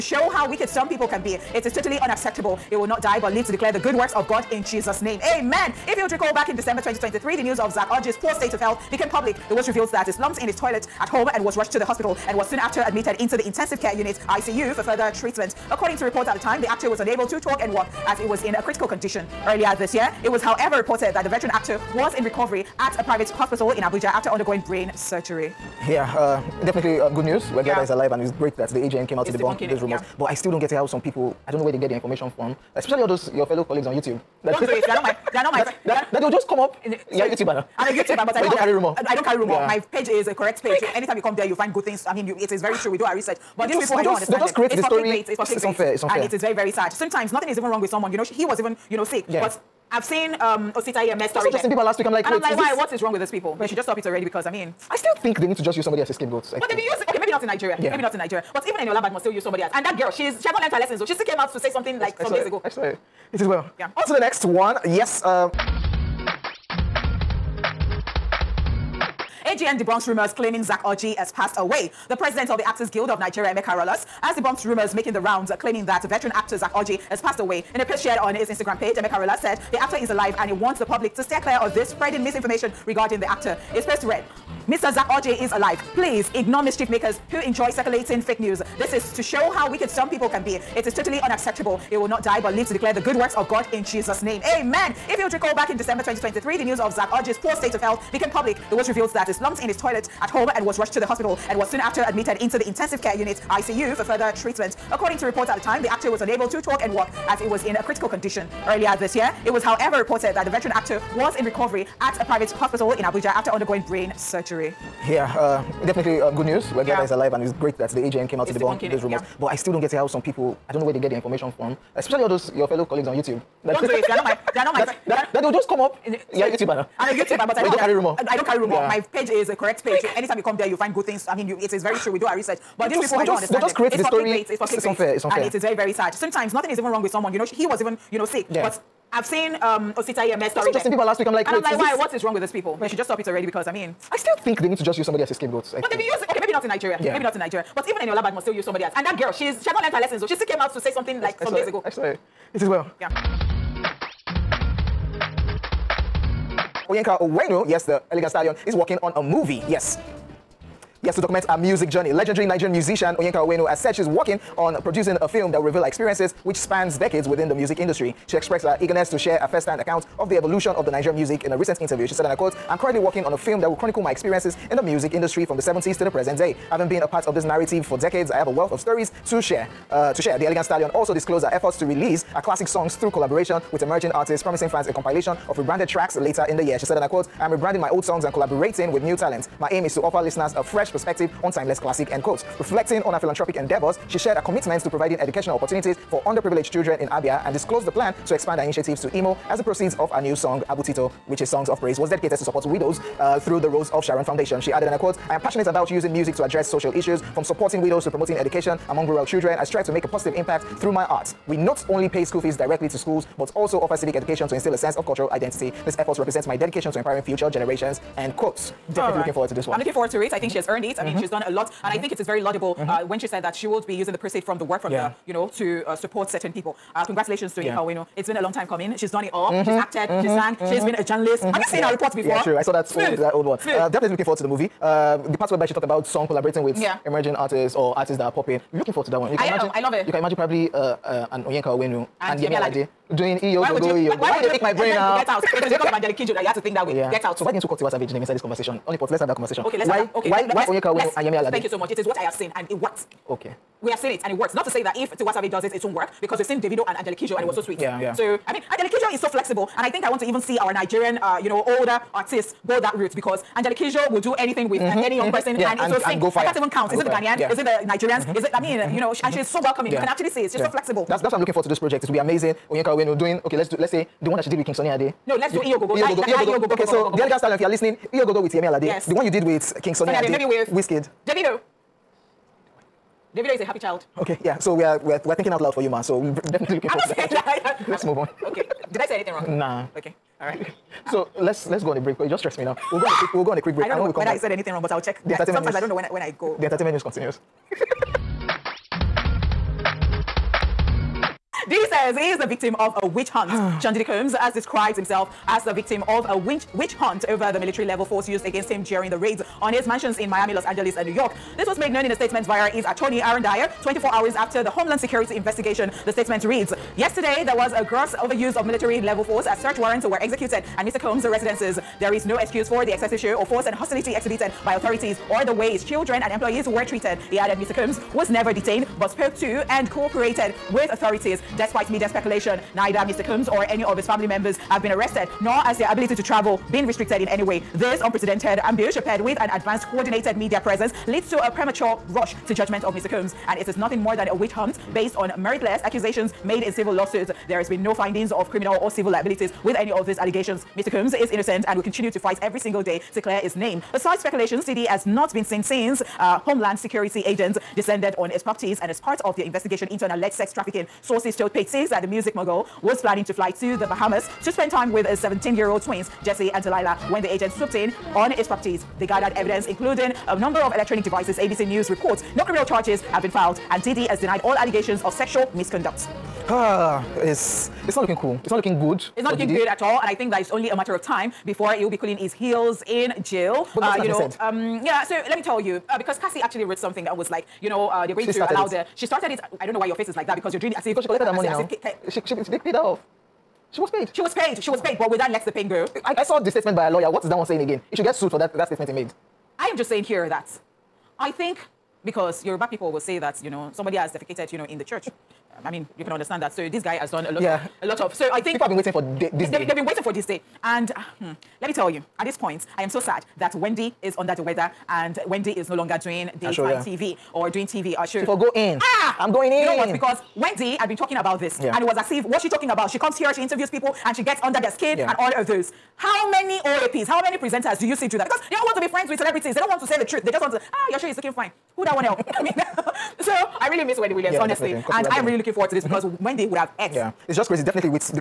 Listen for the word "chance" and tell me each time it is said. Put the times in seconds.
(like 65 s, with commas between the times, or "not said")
not said.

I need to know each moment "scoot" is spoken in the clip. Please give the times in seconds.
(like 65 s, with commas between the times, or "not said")
not said.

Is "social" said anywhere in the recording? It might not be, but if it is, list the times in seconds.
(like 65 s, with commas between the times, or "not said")
206 s.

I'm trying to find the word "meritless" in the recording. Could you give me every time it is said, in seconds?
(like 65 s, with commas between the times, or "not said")
345 s.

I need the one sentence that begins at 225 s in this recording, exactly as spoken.
the, you know, to uh, support certain people.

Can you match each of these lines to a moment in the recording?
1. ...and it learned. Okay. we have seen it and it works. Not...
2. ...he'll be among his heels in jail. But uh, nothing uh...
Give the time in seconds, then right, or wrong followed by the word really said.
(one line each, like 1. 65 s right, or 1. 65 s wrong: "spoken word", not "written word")
1. 252 s wrong: "worked", not "learned"
2. 381 s wrong: "cooling", not "among".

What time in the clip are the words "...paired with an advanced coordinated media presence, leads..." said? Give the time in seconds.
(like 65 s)
339 s.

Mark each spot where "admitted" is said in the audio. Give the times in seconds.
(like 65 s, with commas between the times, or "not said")
12 s, 102 s.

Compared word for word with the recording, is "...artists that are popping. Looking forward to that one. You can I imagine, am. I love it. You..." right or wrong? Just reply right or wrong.
right.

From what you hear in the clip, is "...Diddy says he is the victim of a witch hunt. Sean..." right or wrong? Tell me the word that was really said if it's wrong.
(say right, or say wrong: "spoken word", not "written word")
right.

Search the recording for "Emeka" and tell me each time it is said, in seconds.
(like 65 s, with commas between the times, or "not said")
73 s, 78 s.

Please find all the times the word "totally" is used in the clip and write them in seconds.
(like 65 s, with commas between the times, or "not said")
1 s, 90 s.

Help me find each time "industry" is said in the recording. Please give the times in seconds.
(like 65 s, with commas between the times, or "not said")
167 s, 175 s.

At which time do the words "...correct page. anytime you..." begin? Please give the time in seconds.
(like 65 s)
40 s.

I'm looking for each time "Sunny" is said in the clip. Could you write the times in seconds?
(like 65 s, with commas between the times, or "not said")
274 s, 279 s.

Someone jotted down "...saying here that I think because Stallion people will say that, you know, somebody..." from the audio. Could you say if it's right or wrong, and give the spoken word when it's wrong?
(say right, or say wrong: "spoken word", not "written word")
wrong: "Yoruba", not "Stallion".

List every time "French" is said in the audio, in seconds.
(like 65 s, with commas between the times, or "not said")
not said.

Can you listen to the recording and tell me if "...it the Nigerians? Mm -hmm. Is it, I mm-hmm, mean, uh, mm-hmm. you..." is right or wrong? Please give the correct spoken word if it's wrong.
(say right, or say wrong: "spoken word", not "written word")
right.